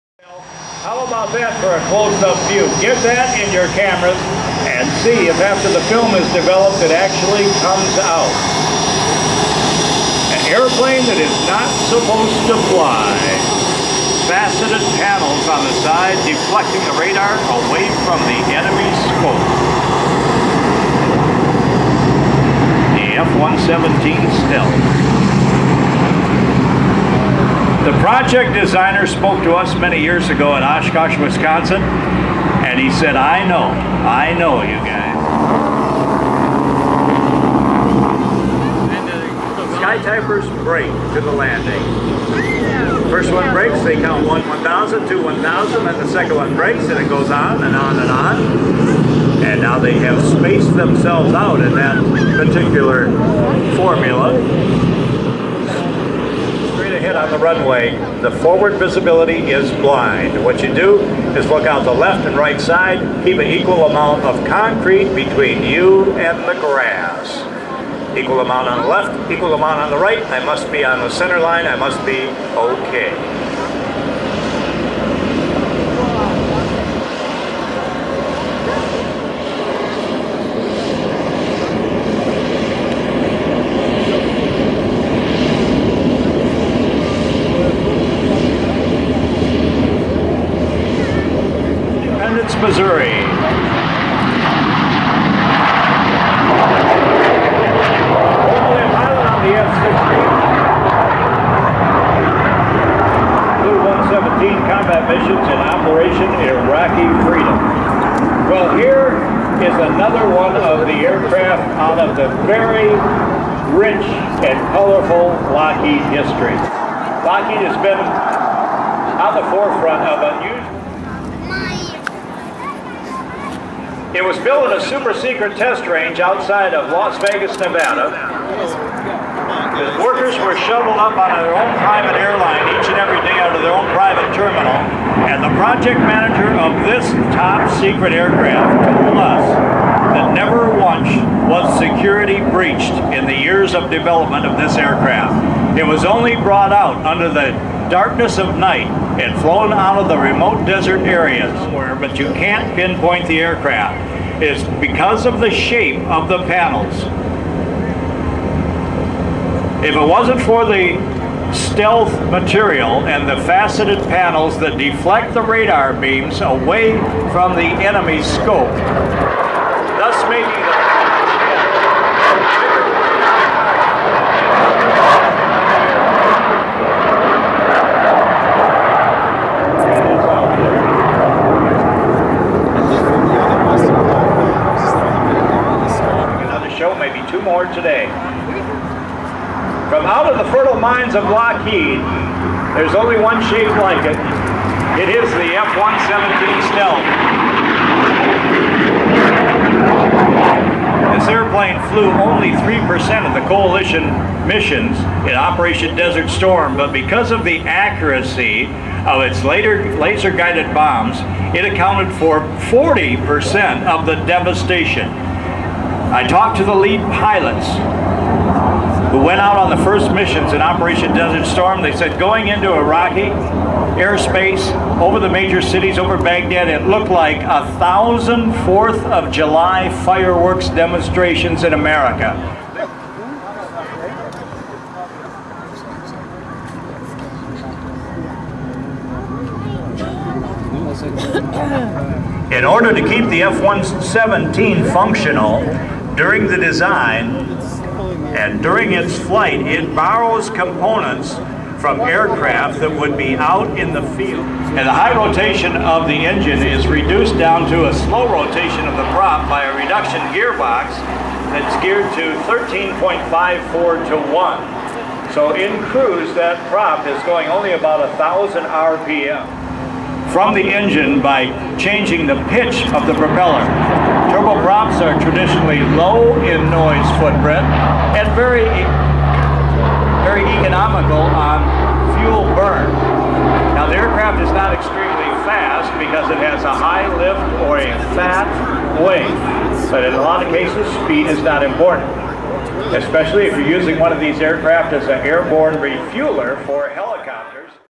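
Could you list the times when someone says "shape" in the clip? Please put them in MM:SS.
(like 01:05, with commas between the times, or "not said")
02:35, 03:13.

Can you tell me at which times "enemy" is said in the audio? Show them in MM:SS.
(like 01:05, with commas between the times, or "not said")
00:18, 02:47.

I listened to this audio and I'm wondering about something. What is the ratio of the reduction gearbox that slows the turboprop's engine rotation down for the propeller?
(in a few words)
13.54 to 1.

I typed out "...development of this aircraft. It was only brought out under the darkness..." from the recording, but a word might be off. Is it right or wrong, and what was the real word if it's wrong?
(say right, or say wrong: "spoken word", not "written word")
right.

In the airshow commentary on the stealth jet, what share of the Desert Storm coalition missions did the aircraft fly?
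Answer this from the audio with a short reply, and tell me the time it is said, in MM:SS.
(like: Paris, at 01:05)
3%, at 03:22.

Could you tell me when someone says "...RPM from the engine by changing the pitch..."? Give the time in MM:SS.
04:28.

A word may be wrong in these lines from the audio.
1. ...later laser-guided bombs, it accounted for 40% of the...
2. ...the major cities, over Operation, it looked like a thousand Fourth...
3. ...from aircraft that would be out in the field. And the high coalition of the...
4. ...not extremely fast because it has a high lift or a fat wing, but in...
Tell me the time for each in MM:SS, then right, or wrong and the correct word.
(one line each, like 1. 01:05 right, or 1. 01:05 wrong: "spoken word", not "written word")
1. 03:29 right
2. 03:45 wrong: "Baghdad", not "Operation"
3. 04:11 wrong: "rotation", not "coalition"
4. 04:44 right.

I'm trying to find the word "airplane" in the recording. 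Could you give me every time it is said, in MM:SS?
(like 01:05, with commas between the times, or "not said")
00:10, 03:21.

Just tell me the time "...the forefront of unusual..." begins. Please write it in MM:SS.
01:59.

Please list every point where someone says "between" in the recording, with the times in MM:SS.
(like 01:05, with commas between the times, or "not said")
01:05.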